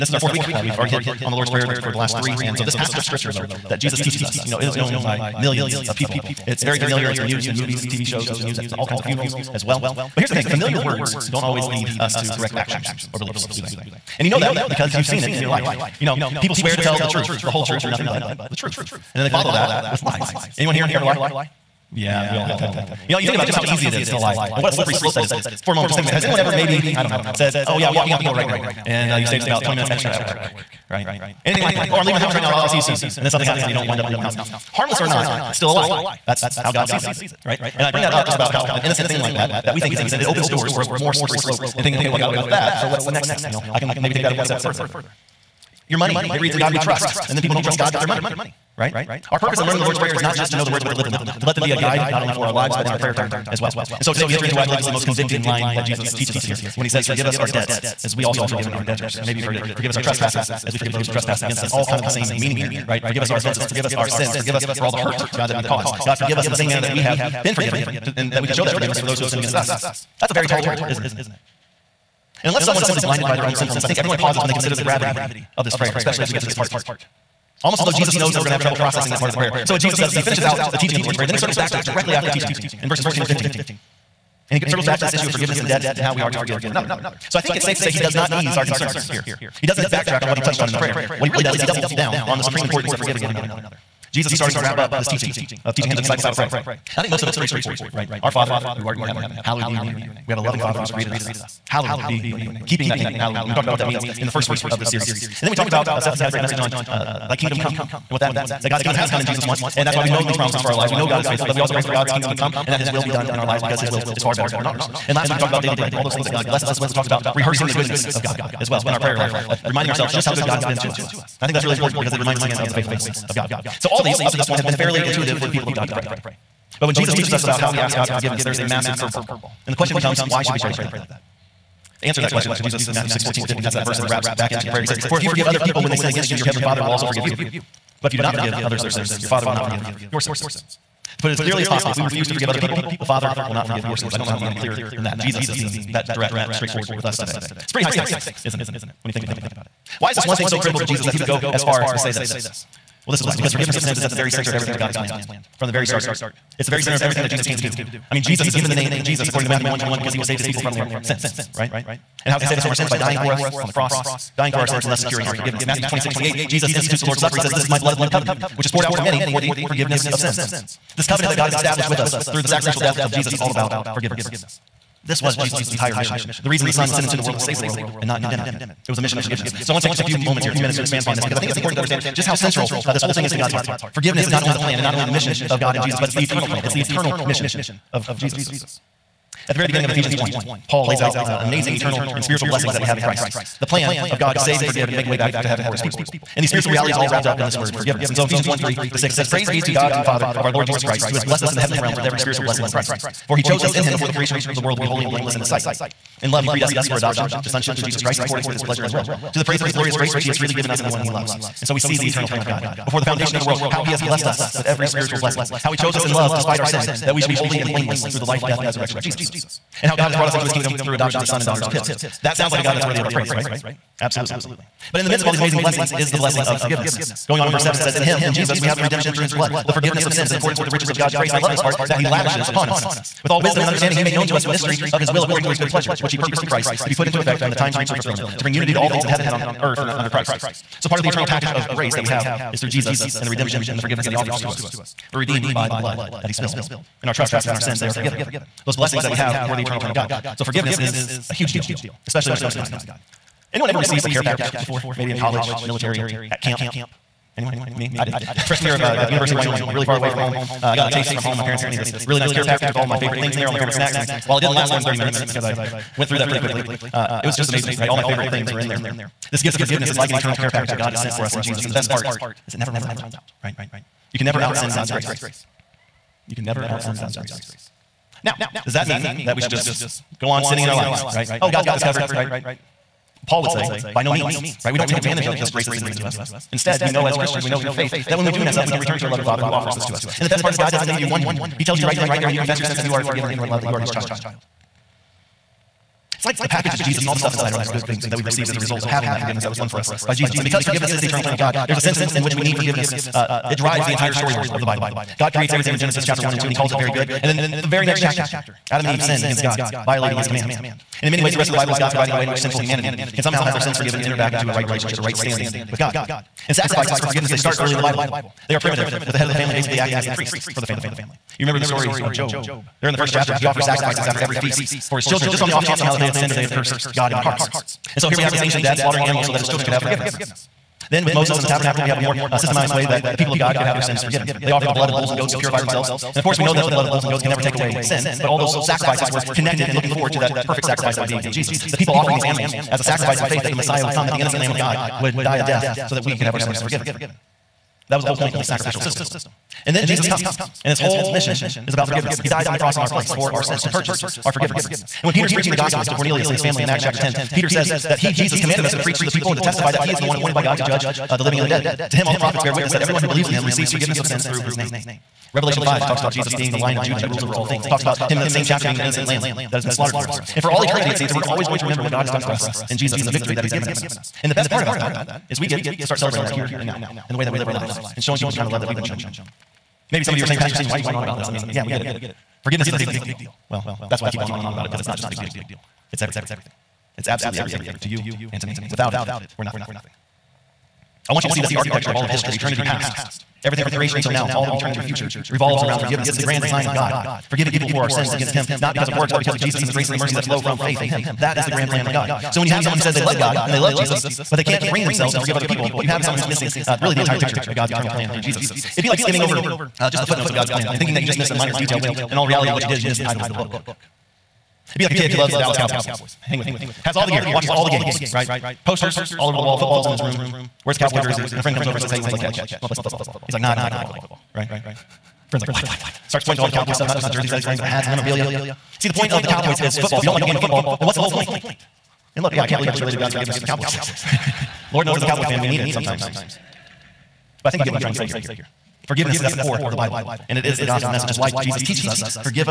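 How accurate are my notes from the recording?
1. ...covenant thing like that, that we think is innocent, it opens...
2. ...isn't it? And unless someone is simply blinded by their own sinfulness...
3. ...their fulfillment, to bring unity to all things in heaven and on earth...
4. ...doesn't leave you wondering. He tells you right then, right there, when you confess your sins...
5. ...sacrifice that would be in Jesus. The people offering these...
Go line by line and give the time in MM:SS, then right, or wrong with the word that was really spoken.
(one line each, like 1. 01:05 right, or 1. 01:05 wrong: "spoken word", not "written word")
1. 00:38 wrong: "innocent", not "covenant"
2. 01:10 right
3. 03:57 right
4. 04:50 right
5. 05:40 right.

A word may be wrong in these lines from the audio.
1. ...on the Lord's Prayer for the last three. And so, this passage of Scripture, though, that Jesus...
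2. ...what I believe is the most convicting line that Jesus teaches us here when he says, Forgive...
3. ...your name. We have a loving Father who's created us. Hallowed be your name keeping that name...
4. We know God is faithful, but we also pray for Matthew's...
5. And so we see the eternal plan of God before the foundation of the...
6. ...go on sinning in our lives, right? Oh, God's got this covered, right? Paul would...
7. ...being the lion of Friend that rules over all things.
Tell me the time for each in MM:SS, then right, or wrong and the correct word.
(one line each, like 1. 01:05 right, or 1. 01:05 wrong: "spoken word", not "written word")
1. 00:01 right
2. 00:54 right
3. 01:39 right
4. 01:50 wrong: "God", not "Matthew"
5. 03:31 right
6. 04:40 right
7. 06:06 wrong: "Judah", not "Friend".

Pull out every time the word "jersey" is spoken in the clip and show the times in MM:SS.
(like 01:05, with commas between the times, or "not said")
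07:00, 07:07.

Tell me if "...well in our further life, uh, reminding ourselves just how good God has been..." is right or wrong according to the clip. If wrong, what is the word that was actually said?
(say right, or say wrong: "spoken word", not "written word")
wrong: "prayer", not "further".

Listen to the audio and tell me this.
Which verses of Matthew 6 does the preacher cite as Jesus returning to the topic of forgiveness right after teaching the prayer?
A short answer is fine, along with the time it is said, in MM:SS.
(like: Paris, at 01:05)
14 and 15, at 01:23.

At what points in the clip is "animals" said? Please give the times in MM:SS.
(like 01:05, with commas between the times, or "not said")
05:29, 05:42.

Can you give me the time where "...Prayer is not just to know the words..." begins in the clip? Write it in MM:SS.
00:49.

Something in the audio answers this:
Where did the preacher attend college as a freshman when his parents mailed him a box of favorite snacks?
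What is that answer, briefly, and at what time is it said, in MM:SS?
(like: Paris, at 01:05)
University of Wyoming, at 04:19.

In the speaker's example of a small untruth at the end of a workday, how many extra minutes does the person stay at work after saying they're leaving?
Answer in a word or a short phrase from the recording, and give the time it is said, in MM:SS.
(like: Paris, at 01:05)
20, at 00:29.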